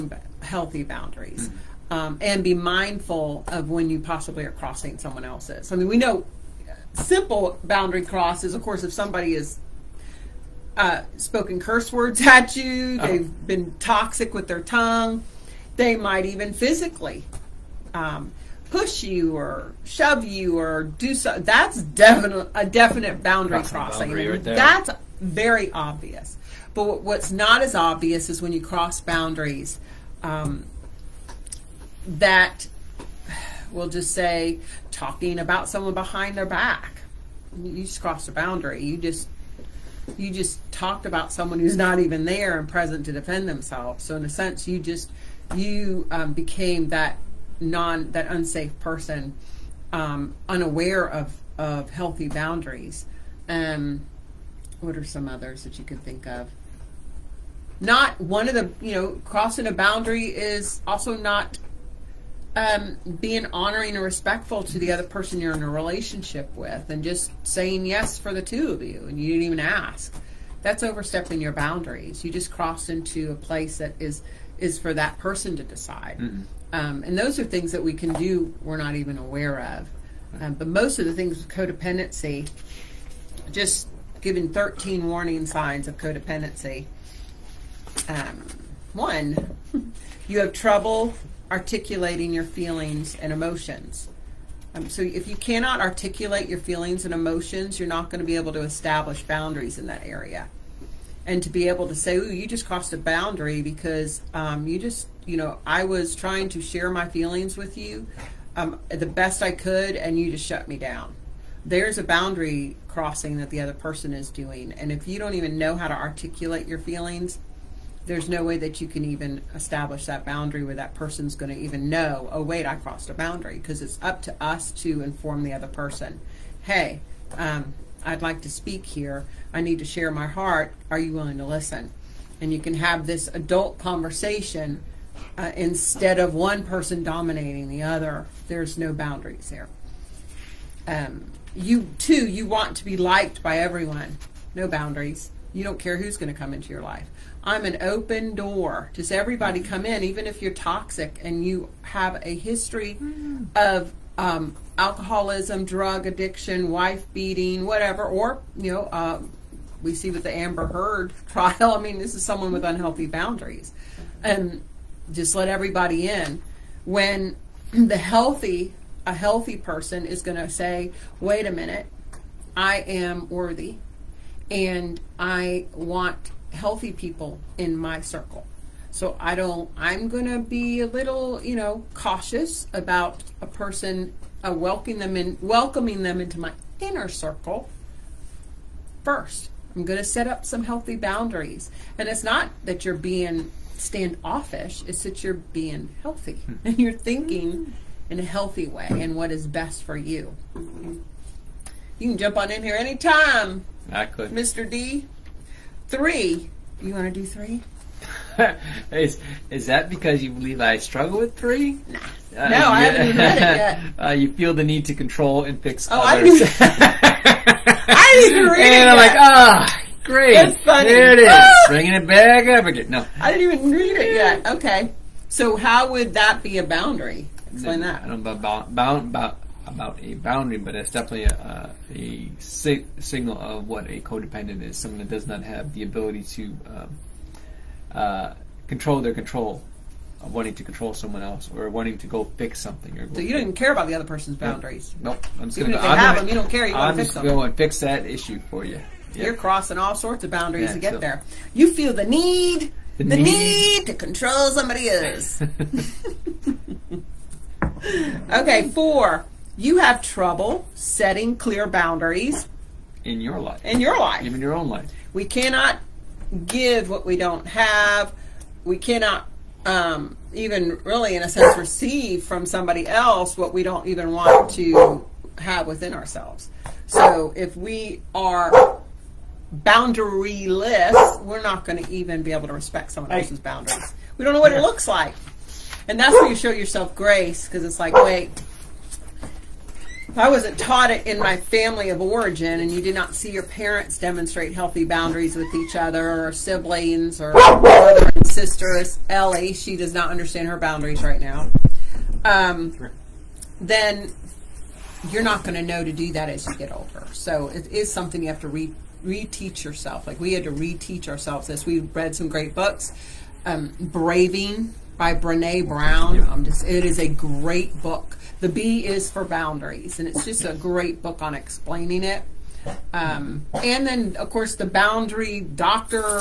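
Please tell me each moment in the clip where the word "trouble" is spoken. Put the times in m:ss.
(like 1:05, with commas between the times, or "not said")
1:30, 4:20.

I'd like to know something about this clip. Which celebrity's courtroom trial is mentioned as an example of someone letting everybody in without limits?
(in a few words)
Amber Heard.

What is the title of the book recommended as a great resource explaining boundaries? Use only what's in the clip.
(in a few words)
Braving.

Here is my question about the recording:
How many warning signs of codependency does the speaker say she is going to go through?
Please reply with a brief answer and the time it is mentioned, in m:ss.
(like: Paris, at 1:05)
13, at 1:24.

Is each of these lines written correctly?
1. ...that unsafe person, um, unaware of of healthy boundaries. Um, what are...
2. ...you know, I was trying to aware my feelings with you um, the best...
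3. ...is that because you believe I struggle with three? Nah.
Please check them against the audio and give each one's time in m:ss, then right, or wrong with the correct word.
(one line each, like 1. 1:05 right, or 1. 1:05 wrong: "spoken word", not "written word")
1. 0:48 right
2. 1:45 wrong: "share", not "aware"
3. 3:29 right.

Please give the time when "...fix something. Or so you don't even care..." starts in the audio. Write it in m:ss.
4:02.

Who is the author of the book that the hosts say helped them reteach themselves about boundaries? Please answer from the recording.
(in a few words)
Brene Brown.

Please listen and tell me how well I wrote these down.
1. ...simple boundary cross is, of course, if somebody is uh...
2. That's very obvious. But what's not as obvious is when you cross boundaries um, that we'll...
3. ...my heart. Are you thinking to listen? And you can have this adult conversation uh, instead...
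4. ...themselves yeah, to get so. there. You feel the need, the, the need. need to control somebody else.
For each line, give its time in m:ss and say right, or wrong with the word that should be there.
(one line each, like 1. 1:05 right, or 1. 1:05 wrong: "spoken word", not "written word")
1. 0:06 right
2. 0:24 right
3. 2:10 wrong: "willing", not "thinking"
4. 4:10 wrong: "boundaries", not "themselves".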